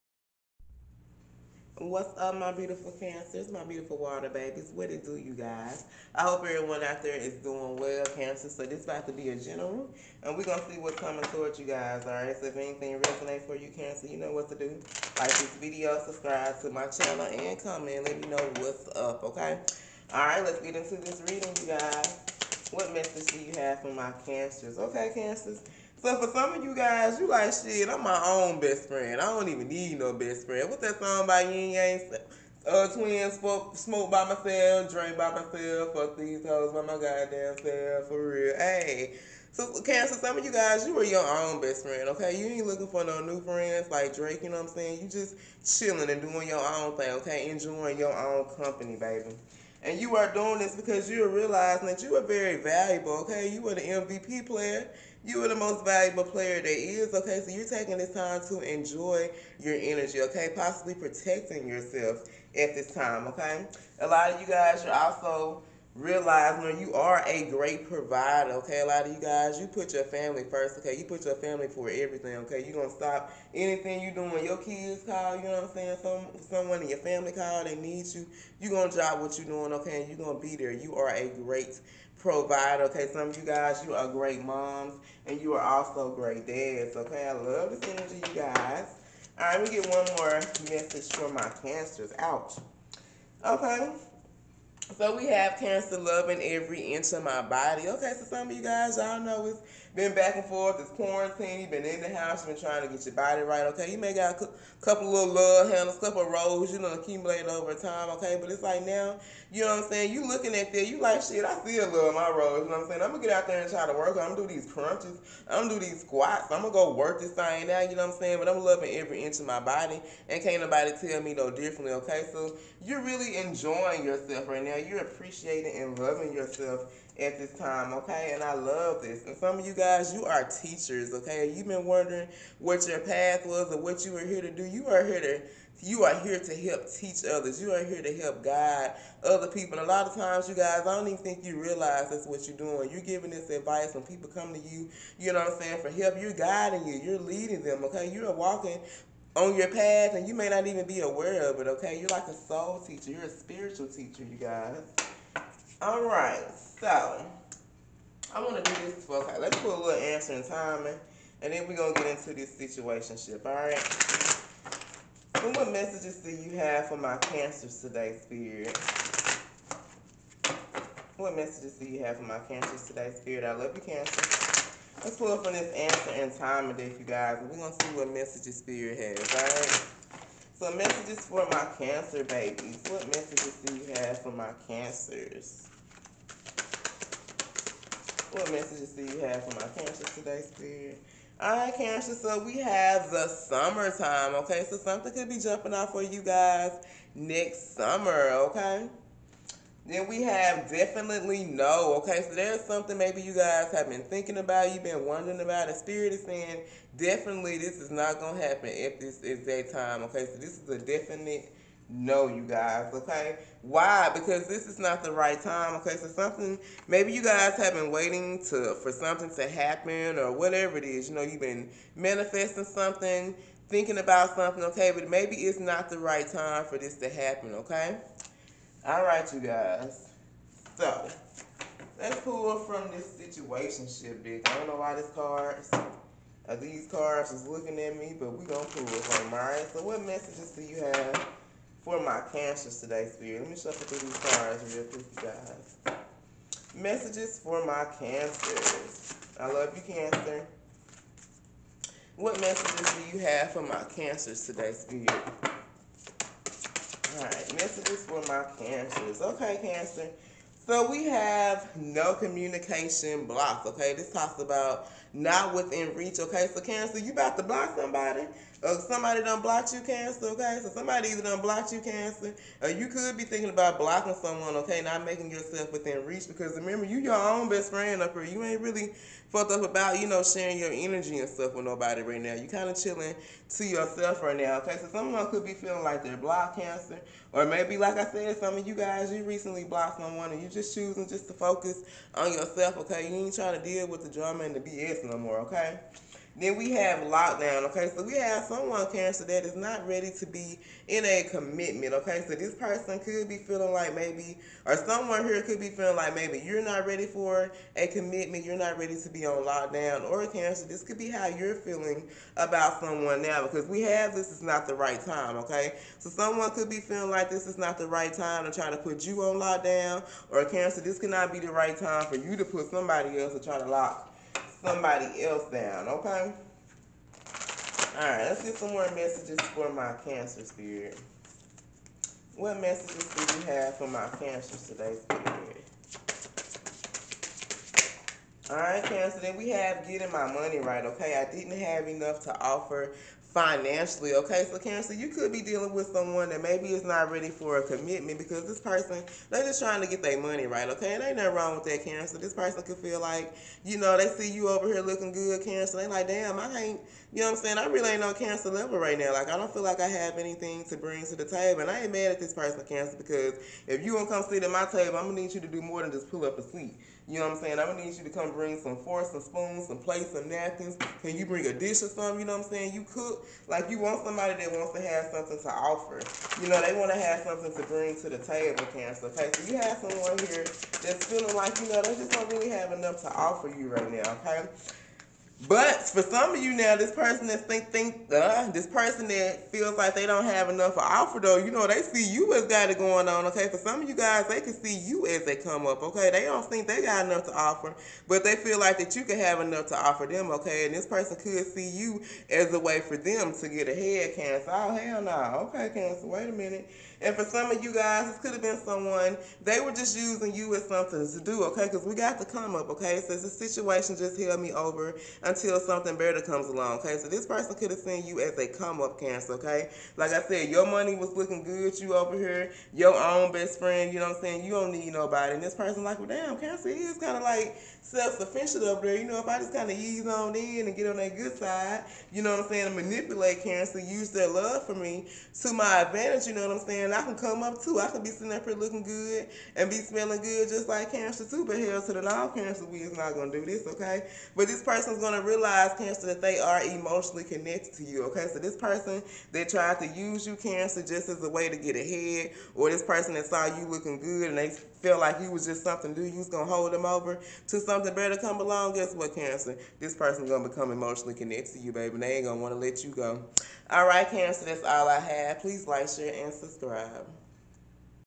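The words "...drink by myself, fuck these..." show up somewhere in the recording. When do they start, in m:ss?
0:34.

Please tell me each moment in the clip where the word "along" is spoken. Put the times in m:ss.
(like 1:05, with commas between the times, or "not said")
6:56, 7:38.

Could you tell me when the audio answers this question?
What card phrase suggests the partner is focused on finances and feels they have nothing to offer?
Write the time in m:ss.
5:39.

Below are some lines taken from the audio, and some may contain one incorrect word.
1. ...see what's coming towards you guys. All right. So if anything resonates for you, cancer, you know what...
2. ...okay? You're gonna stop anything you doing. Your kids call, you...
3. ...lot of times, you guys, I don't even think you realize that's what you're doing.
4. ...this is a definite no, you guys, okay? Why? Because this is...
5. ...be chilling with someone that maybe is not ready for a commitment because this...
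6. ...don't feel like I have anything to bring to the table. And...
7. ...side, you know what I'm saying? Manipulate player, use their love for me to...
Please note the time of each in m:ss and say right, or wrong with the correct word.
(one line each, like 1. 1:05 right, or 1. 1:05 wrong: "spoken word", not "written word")
1. 0:10 right
2. 1:12 right
3. 2:19 right
4. 3:30 right
5. 5:45 wrong: "dealing", not "chilling"
6. 5:59 right
7. 7:11 wrong: "cancer", not "player".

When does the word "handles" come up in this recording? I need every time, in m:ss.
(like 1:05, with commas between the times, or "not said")
1:45.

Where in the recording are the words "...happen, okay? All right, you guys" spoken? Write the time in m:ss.
3:47.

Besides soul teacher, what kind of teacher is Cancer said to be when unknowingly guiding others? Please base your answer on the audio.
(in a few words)
spiritual teacher.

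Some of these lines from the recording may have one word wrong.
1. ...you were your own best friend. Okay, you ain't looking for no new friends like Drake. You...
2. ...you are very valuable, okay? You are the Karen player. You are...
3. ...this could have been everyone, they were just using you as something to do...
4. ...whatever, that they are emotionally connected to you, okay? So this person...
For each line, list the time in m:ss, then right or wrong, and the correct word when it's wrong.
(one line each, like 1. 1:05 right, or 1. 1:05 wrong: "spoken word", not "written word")
1. 0:40 right
2. 0:52 wrong: "MVP", not "Karen"
3. 6:48 wrong: "someone", not "everyone"
4. 7:25 wrong: "cancer", not "whatever".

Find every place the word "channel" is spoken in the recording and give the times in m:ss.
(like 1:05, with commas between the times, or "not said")
0:16.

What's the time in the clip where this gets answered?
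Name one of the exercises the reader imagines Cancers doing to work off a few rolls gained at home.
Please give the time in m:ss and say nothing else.
1:54.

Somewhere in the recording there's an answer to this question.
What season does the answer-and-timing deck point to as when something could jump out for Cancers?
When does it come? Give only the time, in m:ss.
3:13.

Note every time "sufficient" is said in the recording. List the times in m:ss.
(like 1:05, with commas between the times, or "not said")
7:08.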